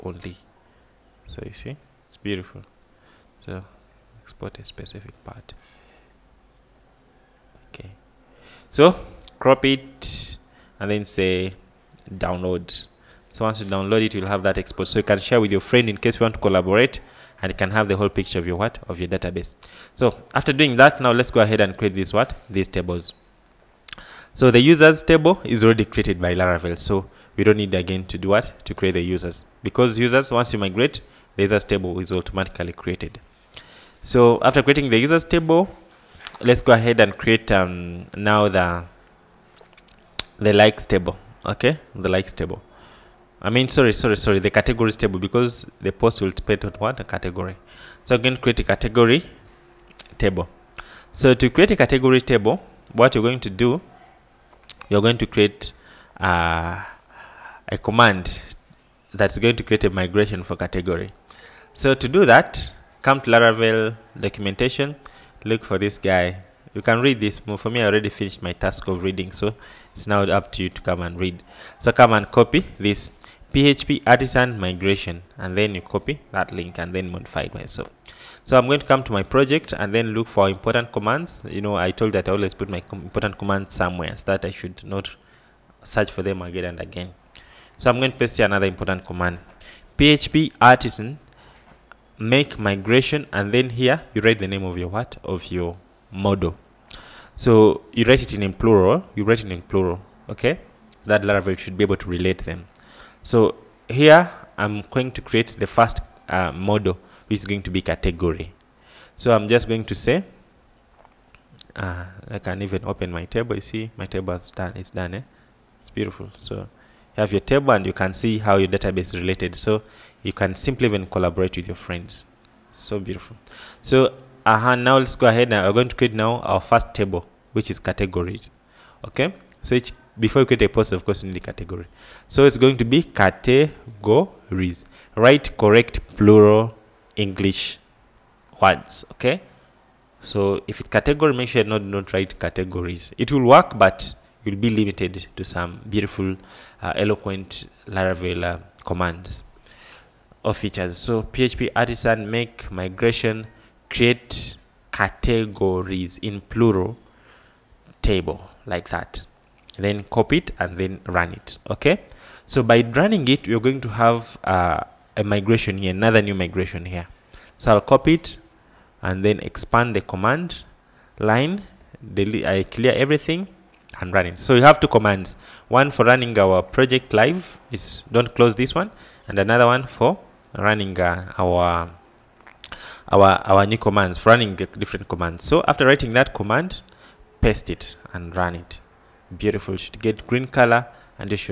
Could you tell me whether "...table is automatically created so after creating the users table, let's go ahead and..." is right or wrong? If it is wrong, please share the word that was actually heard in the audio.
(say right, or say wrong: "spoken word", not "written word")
right.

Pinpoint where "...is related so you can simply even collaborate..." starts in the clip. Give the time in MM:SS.
01:59.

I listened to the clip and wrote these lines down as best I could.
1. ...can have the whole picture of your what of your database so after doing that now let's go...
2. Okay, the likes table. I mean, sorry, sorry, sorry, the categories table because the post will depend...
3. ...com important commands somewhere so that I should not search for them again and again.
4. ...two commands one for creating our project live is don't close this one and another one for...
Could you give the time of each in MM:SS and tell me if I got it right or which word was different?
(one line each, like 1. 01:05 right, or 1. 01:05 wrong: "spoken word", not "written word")
1. 00:17 right
2. 00:41 right
3. 01:22 right
4. 02:54 wrong: "running", not "creating".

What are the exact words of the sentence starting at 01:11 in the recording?
So come and copy this PHP artisan migration, and then you copy that link and then modify it myself.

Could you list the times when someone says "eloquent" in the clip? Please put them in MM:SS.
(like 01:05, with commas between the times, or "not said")
02:26.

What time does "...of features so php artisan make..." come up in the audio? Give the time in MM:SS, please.
02:30.